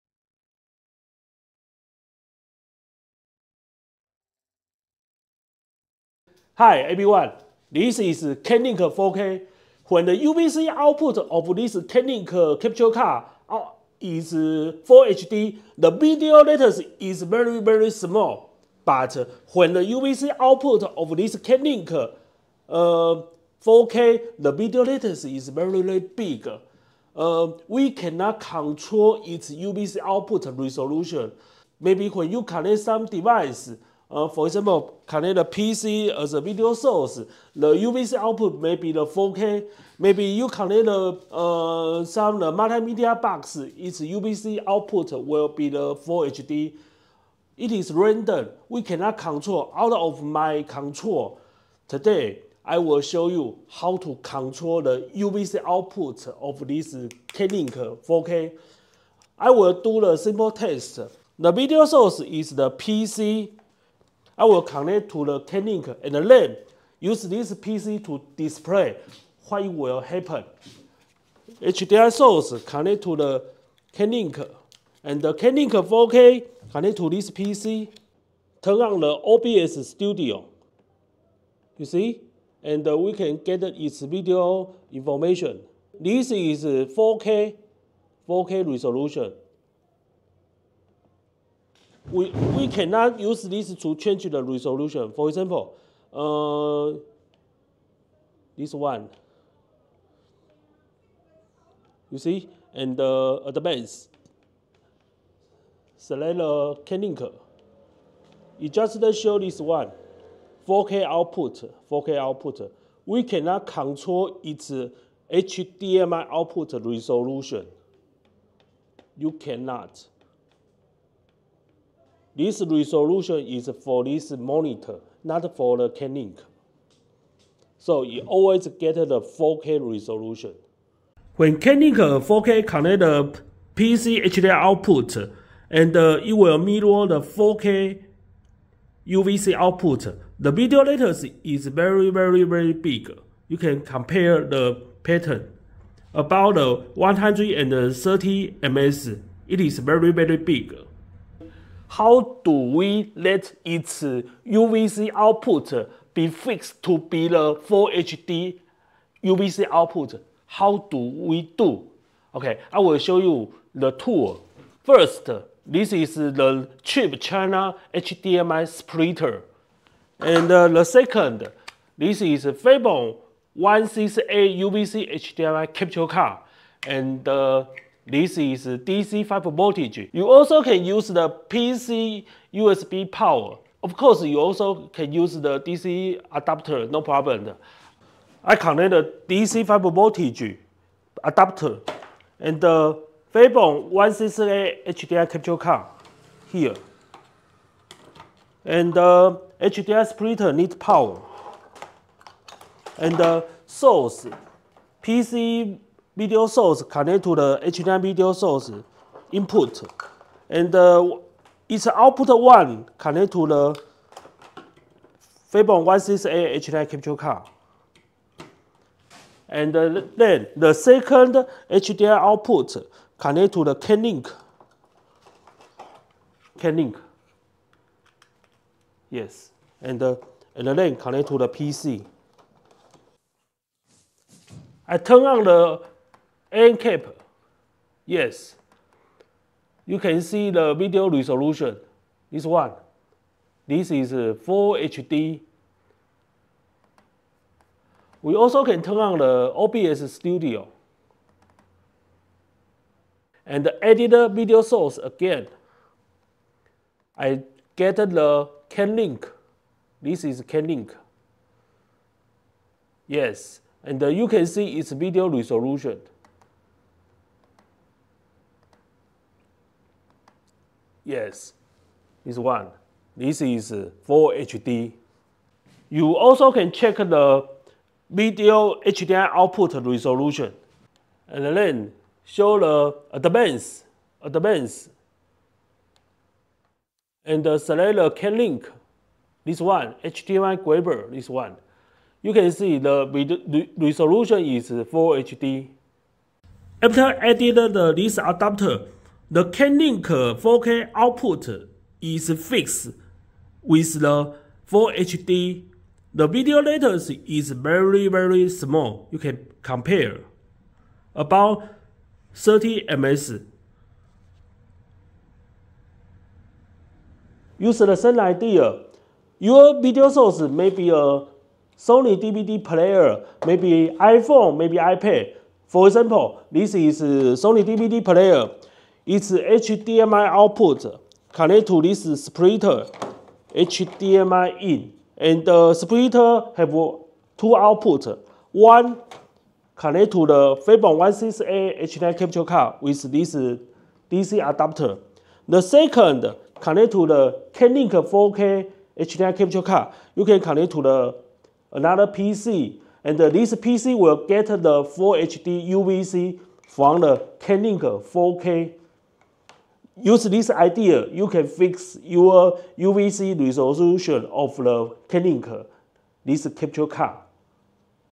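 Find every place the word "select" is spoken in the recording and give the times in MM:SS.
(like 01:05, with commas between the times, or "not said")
01:45, 04:47.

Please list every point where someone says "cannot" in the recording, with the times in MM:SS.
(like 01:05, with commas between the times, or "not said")
00:27, 00:48, 01:32, 01:53, 01:59.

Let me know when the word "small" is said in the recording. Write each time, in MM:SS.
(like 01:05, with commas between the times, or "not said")
00:17, 05:08.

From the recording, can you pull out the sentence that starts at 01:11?
HDMI source connect to the k and the k 4K connect to this PC, turn on the OBS Studio.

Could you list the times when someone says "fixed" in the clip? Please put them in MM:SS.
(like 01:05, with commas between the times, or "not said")
02:36, 05:02.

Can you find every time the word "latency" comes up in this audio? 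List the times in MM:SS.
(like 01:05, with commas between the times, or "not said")
00:16, 00:24, 02:20, 05:06.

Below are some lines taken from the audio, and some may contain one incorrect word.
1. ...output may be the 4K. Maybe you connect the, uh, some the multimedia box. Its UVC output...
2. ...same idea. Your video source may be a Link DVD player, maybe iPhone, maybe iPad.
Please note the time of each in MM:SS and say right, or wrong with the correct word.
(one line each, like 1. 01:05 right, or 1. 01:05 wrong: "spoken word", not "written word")
1. 00:38 right
2. 05:17 wrong: "Sony", not "Link".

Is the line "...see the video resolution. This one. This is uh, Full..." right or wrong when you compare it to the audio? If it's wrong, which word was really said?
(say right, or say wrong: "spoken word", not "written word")
right.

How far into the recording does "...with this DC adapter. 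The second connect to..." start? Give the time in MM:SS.
05:42.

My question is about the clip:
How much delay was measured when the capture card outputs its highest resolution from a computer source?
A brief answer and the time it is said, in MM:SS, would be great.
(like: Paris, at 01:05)
130 ms, at 02:26.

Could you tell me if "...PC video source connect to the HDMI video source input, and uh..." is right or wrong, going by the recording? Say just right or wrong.
right.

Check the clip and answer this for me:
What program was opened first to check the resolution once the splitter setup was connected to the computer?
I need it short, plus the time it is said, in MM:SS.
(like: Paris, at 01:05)
AmCap, at 03:56.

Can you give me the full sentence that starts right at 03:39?
And uh, then the second HDMI output connect to the Cam Link.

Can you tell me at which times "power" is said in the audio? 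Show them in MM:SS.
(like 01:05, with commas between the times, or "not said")
03:03, 03:20.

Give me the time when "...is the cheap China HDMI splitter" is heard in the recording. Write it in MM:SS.
02:45.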